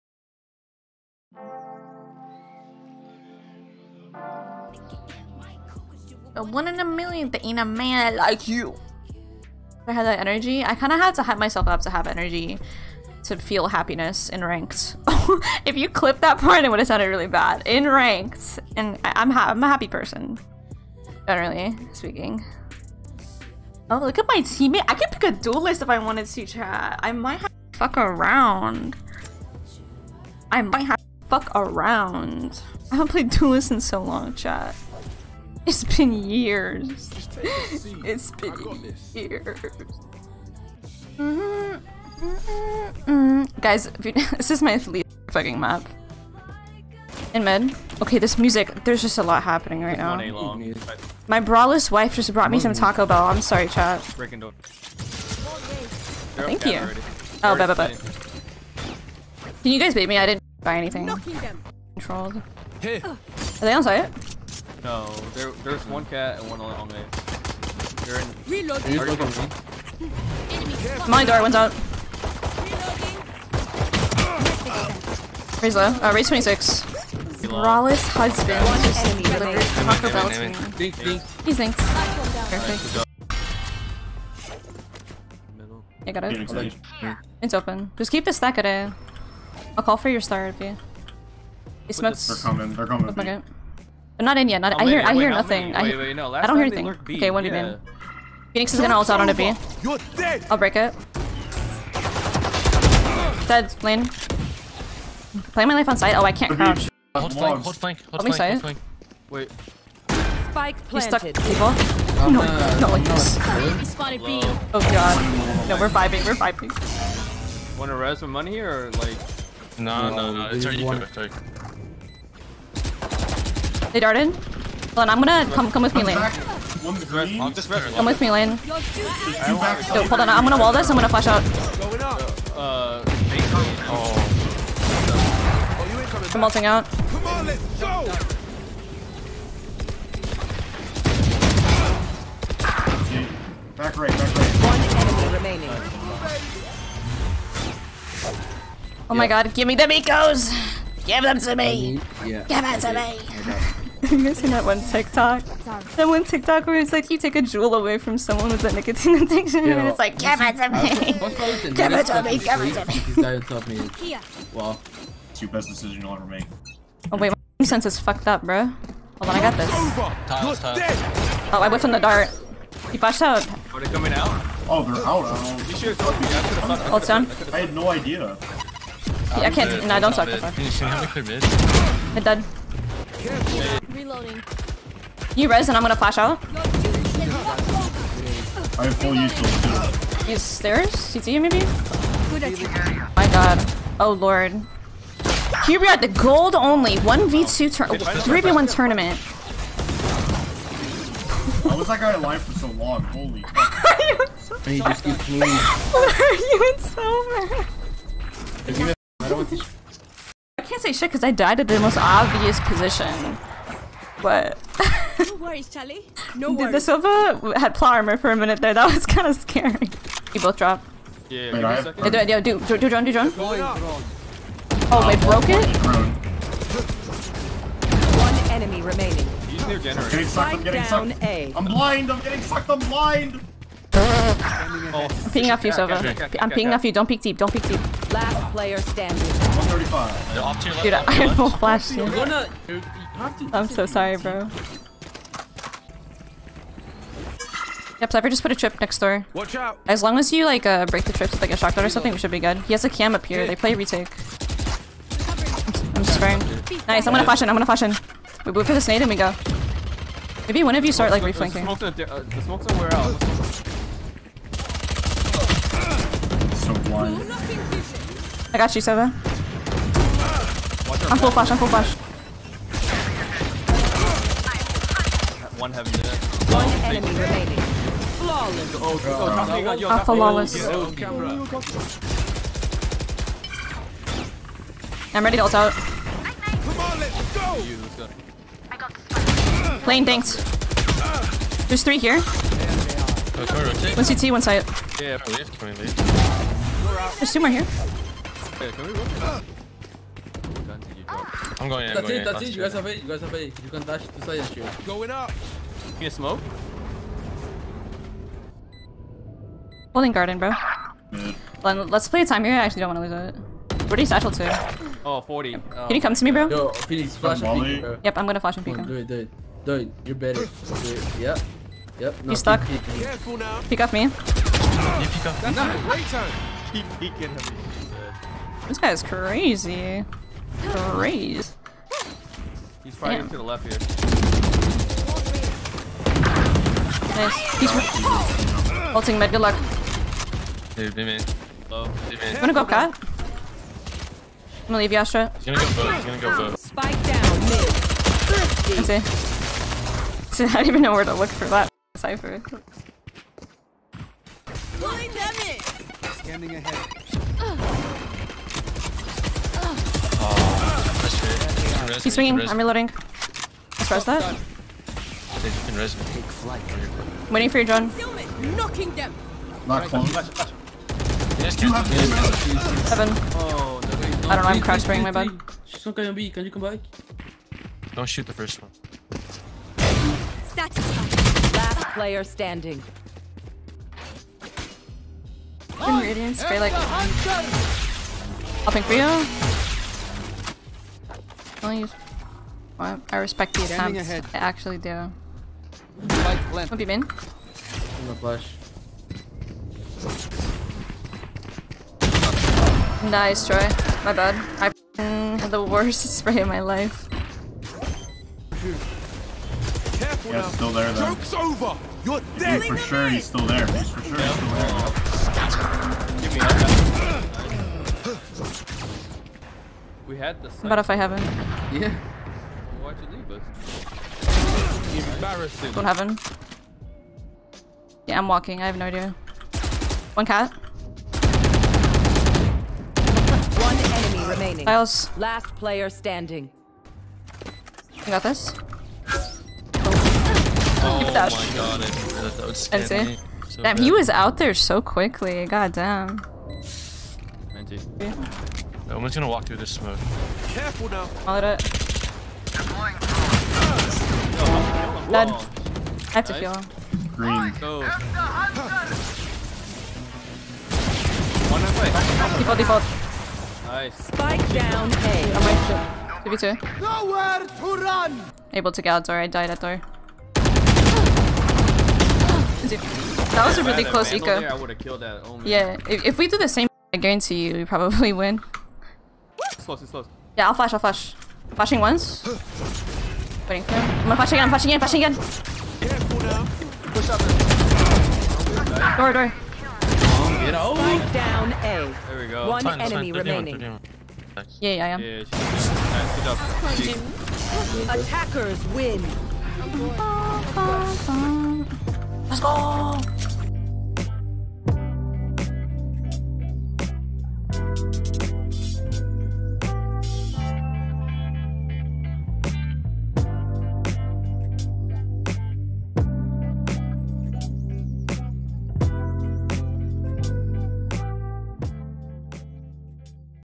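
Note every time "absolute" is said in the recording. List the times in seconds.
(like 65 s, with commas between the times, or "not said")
not said.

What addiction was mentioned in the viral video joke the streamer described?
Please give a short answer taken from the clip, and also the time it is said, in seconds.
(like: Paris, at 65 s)
nicotine, at 158 s.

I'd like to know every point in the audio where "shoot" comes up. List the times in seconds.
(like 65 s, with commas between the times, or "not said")
304 s, 378 s.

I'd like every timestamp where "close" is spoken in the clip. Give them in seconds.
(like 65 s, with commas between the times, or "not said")
369 s, 473 s.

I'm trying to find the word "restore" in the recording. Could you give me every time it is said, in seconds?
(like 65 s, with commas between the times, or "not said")
not said.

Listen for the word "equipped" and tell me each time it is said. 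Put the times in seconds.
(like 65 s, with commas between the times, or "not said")
not said.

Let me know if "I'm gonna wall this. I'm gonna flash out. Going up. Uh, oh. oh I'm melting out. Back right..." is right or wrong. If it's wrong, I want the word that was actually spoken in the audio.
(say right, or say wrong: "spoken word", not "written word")
right.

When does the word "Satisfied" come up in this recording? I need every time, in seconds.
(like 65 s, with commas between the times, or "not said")
380 s.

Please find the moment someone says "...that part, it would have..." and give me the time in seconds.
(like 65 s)
16 s.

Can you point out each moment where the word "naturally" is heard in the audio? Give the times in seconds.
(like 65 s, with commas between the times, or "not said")
not said.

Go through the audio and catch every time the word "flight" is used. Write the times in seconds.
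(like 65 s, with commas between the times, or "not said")
366 s.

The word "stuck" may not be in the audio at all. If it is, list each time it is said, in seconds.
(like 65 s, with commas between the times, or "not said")
111 s, 322 s.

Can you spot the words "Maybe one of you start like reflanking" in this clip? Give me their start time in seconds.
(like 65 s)
260 s.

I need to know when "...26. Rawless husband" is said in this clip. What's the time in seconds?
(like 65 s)
76 s.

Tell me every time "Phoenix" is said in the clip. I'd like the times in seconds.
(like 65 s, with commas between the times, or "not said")
98 s, 316 s.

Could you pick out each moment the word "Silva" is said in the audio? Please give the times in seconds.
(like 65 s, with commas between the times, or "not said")
216 s, 235 s.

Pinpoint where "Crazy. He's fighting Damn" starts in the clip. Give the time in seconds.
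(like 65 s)
330 s.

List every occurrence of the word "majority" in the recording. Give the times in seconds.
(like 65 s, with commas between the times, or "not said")
not said.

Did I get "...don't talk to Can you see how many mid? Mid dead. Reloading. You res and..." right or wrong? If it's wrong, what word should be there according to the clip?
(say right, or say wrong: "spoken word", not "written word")
right.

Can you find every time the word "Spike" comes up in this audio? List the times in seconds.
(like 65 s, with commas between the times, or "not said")
110 s, 346 s, 464 s.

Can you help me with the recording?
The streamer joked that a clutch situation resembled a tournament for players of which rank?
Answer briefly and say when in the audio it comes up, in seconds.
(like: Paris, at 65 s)
gold, at 196 s.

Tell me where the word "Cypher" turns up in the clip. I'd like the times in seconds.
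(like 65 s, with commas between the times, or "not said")
248 s, 351 s.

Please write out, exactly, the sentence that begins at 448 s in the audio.
No one's gonna walk through this smoke.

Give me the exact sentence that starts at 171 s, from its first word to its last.
Oh, I whiffed on the dart.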